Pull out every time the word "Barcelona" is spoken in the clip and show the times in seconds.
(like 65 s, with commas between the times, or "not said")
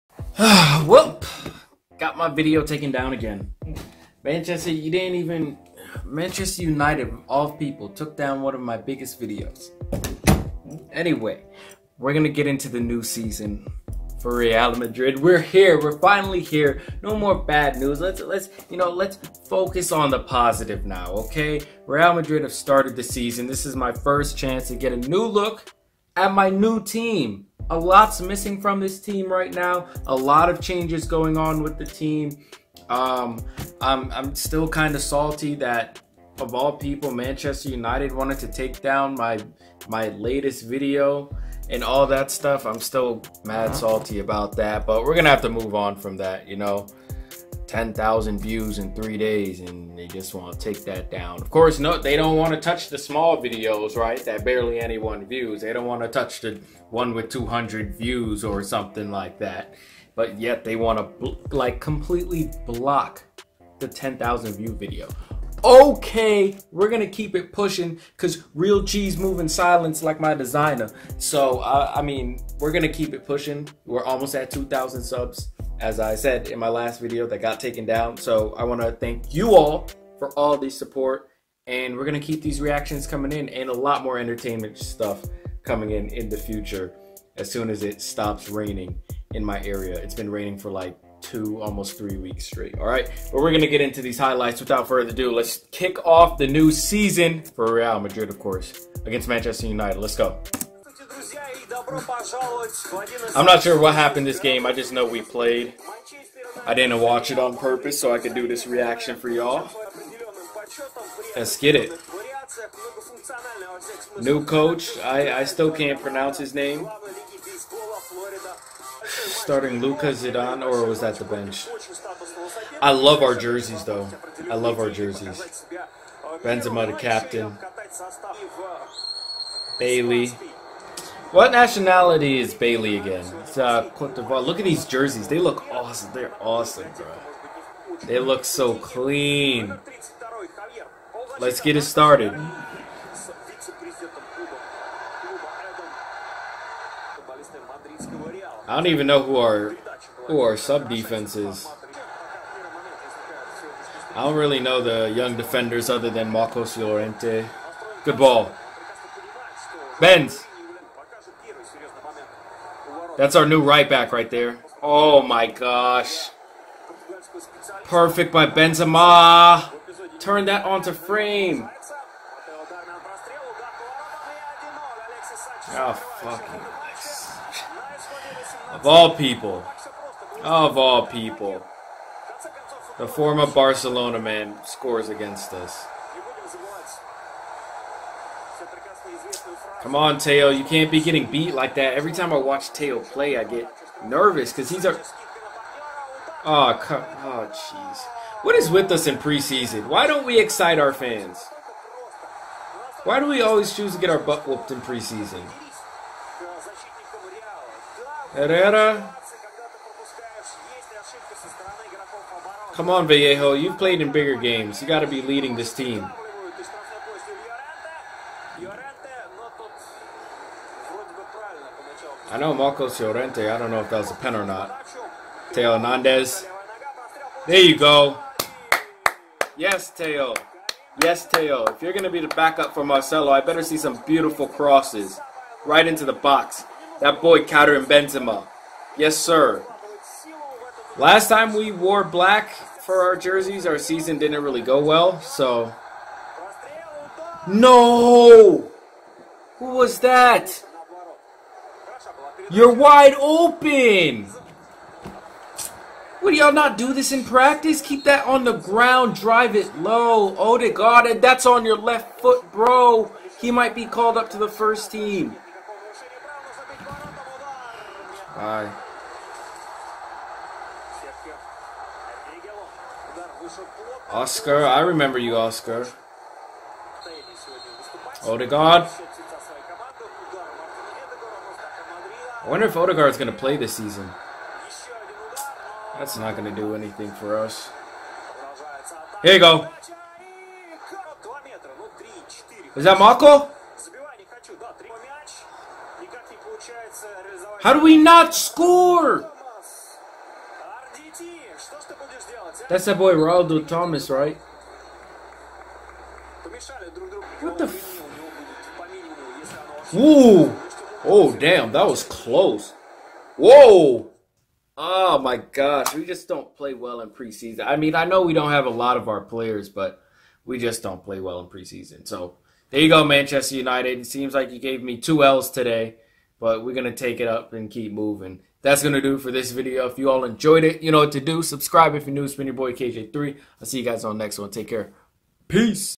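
183 s.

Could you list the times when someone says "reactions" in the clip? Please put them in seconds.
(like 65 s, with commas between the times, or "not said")
82 s, 108 s.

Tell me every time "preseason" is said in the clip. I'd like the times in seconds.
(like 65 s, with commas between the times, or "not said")
199 s, 204 s, 317 s, 321 s.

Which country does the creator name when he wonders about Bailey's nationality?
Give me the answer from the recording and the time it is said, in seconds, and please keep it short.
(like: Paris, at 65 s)
Cote d'Ivoire, at 133 s.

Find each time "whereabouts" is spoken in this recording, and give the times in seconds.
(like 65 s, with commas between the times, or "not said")
not said.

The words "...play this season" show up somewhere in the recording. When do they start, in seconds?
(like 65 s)
283 s.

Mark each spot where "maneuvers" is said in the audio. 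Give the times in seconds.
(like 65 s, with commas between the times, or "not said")
not said.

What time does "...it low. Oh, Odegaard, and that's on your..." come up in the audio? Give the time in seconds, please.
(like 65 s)
259 s.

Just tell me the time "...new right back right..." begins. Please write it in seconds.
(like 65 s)
163 s.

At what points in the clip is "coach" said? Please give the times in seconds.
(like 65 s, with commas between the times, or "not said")
114 s.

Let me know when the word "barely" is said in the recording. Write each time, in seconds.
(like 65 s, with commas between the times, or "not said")
54 s.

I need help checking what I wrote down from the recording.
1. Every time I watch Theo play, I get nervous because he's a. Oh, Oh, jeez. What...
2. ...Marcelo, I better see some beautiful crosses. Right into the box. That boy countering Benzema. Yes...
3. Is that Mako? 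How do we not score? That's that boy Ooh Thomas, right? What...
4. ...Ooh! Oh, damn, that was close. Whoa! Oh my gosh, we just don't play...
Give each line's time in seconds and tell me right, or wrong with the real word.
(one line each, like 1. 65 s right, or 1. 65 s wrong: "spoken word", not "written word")
1. 191 s right
2. 232 s right
3. 292 s wrong: "Ronaldo", not "Ooh"
4. 309 s right.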